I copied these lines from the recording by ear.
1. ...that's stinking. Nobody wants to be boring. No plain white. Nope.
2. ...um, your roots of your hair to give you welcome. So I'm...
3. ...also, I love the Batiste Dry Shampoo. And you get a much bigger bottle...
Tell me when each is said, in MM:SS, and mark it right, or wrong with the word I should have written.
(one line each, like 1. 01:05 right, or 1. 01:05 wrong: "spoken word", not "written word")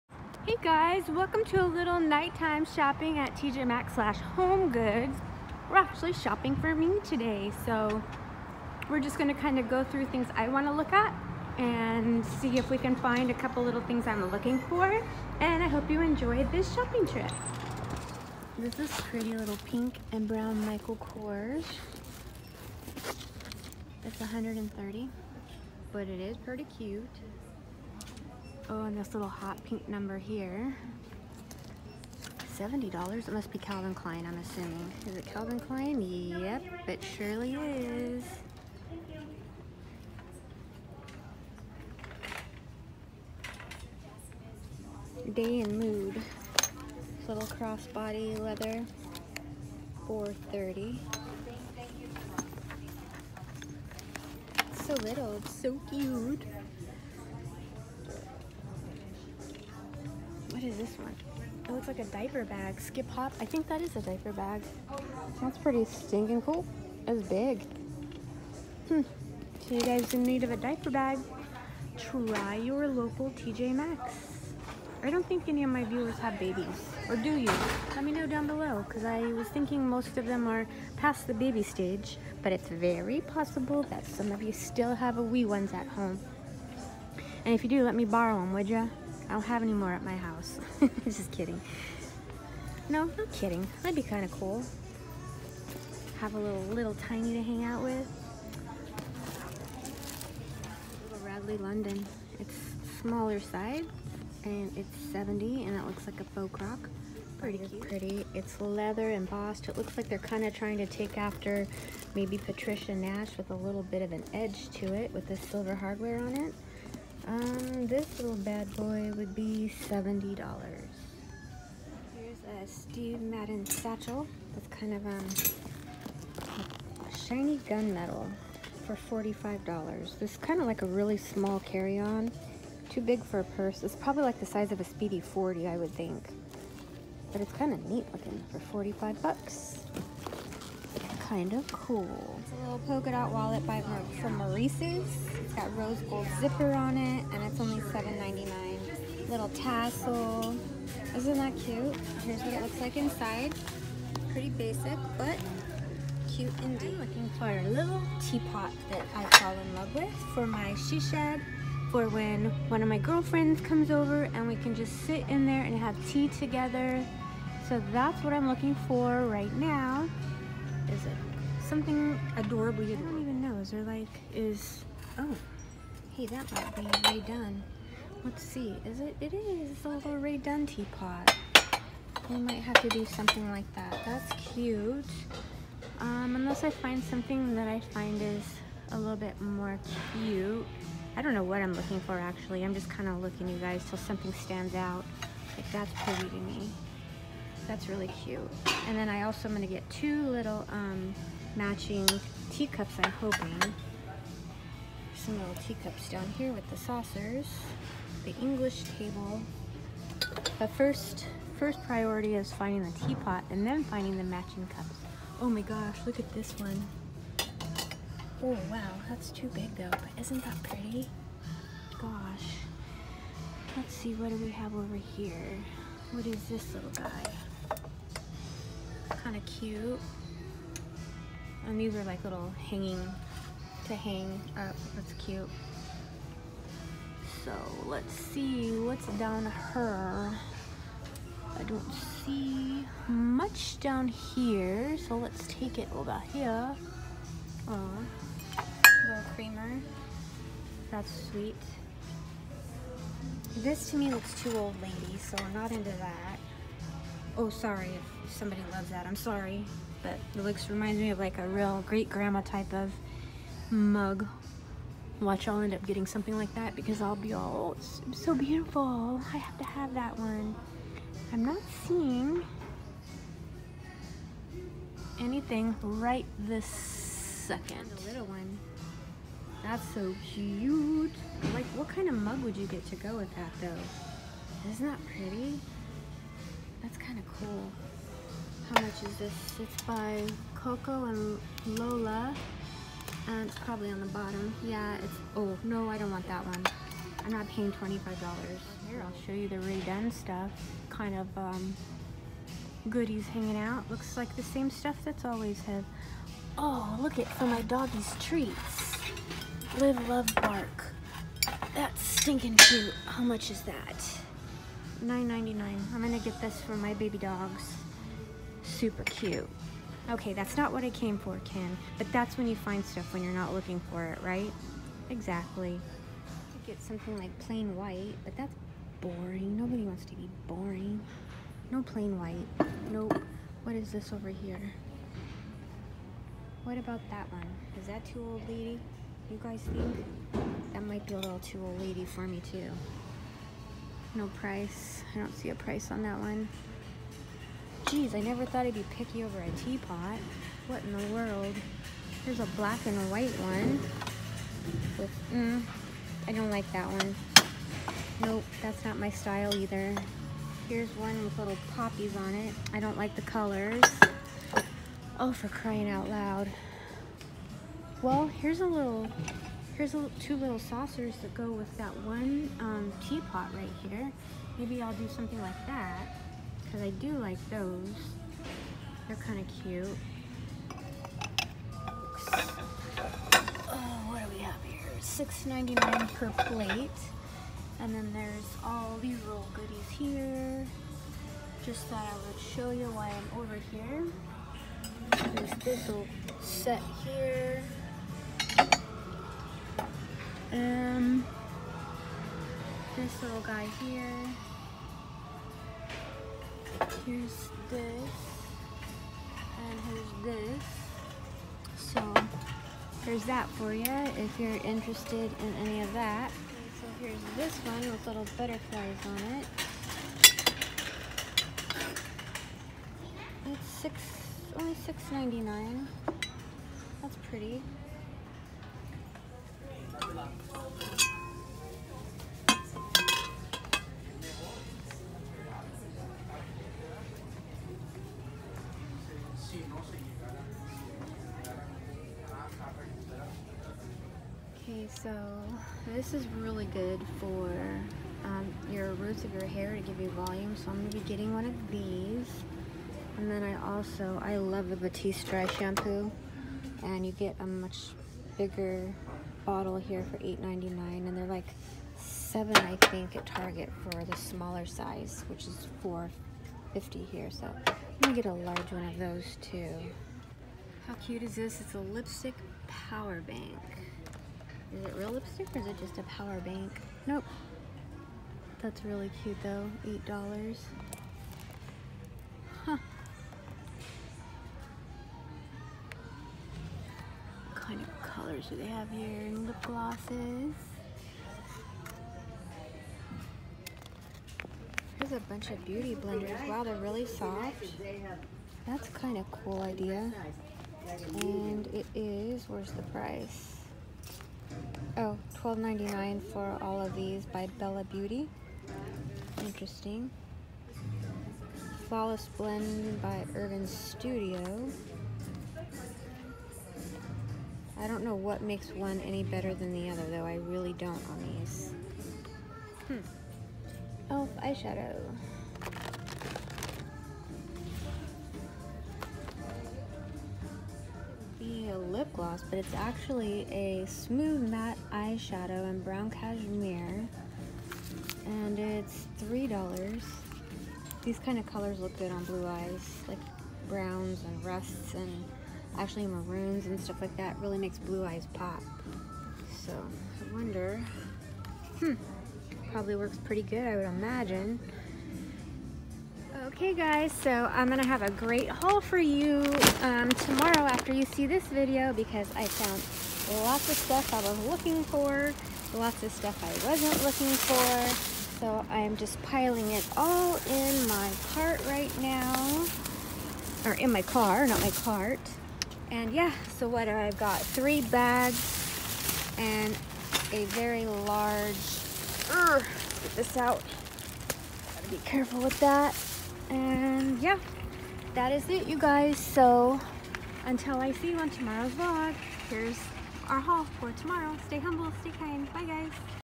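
1. 05:28 wrong: "boring", not "stinking"
2. 07:28 wrong: "volume", not "welcome"
3. 07:33 right.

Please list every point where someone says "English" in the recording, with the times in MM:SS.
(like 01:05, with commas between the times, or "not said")
03:28.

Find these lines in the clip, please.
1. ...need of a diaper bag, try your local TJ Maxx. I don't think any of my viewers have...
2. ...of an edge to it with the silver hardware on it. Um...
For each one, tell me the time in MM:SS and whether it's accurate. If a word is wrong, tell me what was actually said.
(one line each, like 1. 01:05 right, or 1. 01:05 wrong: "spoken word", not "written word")
1. 01:10 right
2. 01:54 right.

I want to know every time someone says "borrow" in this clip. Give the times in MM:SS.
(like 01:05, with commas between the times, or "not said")
01:28.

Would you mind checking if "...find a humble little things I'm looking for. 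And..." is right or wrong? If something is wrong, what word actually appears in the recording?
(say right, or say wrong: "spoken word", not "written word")
wrong: "couple", not "humble".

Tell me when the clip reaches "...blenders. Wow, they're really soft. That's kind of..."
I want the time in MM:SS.
08:15.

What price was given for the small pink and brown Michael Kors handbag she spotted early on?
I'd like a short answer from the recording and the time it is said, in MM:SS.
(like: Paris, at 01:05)
$130, at 00:24.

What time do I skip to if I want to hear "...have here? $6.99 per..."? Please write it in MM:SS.
06:24.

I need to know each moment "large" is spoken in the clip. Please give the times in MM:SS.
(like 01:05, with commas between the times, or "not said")
07:48, 09:40.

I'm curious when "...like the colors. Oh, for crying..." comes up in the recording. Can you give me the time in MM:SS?
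06:02.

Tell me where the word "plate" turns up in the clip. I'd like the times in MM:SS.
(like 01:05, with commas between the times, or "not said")
06:26.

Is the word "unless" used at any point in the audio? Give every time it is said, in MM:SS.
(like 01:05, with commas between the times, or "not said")
03:06.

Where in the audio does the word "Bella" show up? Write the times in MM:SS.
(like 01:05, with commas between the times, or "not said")
08:27.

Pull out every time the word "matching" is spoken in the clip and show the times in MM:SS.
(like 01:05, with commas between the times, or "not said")
03:21, 03:34.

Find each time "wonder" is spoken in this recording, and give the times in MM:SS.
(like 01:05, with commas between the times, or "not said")
09:10.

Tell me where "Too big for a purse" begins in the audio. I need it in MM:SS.
02:12.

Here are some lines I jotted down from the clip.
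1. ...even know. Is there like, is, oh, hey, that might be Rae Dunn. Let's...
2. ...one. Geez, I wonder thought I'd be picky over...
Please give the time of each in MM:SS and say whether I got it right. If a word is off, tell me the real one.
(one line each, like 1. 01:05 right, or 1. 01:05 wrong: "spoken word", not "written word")
1. 02:53 right
2. 05:46 wrong: "never", not "wonder".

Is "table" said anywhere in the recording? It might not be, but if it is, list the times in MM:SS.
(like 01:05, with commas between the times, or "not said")
03:28.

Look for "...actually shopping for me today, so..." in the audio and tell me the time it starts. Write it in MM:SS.
00:05.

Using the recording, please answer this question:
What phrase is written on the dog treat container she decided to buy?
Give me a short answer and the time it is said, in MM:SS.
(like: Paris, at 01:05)
Live, love, bark, at 05:09.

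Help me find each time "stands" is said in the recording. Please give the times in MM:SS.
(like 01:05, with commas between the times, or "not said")
03:14.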